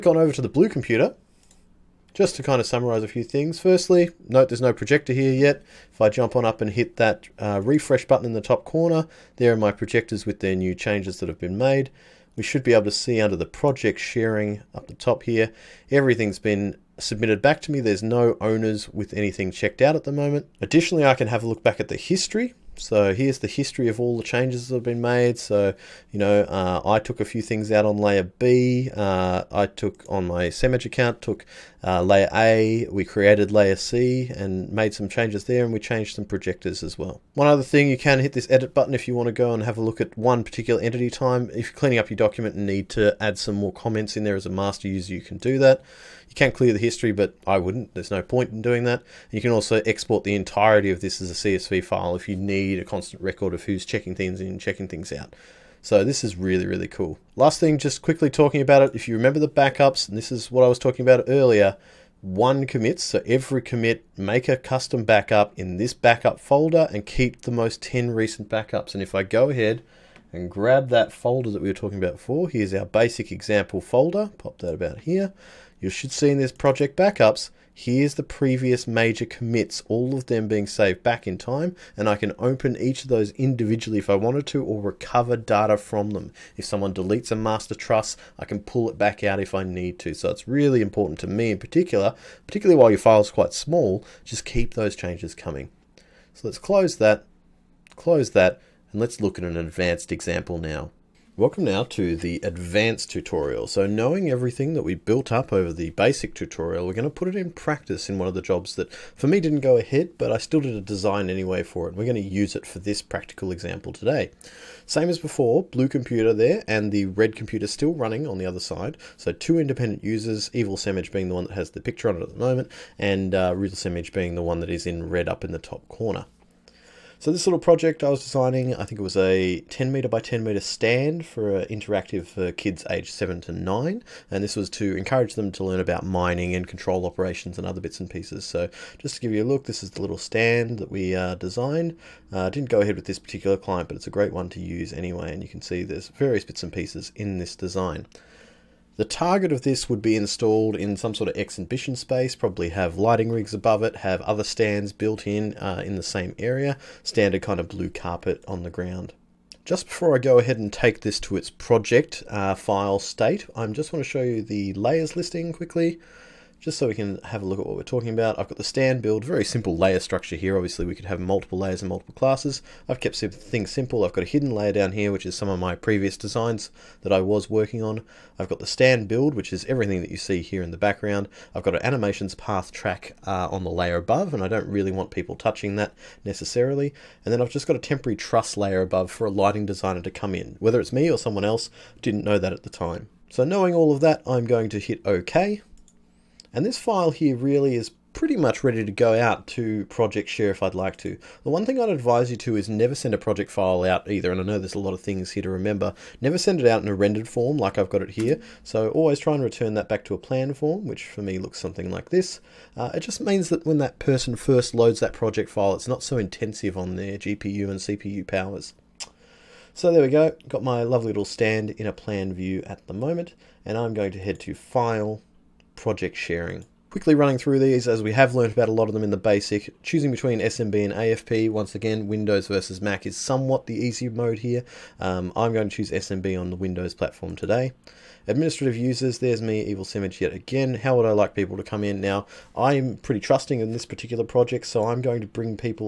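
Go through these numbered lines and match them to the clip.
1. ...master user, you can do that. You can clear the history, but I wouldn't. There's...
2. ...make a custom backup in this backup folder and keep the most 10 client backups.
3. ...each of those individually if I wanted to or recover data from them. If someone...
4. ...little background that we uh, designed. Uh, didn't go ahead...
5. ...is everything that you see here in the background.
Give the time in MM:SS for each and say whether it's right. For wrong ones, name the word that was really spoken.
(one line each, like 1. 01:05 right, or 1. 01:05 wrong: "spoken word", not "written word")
1. 00:44 right
2. 01:04 wrong: "recent", not "client"
3. 01:22 right
4. 02:20 wrong: "stand", not "background"
5. 02:59 right.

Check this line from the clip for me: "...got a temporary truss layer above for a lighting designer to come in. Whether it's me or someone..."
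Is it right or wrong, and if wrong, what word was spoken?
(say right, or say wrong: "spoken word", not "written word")
right.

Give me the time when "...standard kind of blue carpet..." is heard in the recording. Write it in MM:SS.
02:37.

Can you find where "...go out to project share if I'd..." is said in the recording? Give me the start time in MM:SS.
03:18.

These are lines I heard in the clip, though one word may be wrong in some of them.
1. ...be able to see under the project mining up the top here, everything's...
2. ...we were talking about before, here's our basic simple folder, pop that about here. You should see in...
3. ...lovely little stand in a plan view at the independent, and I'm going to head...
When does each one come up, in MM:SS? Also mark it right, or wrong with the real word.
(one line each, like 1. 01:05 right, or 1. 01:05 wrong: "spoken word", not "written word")
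1. 00:12 wrong: "sharing", not "mining"
2. 01:11 wrong: "example", not "simple"
3. 03:40 wrong: "moment", not "independent".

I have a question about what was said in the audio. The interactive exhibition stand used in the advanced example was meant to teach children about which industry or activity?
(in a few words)
Mining.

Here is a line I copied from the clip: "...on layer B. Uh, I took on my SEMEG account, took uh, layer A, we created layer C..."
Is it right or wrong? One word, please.
right.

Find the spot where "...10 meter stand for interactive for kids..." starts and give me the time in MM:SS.
02:10.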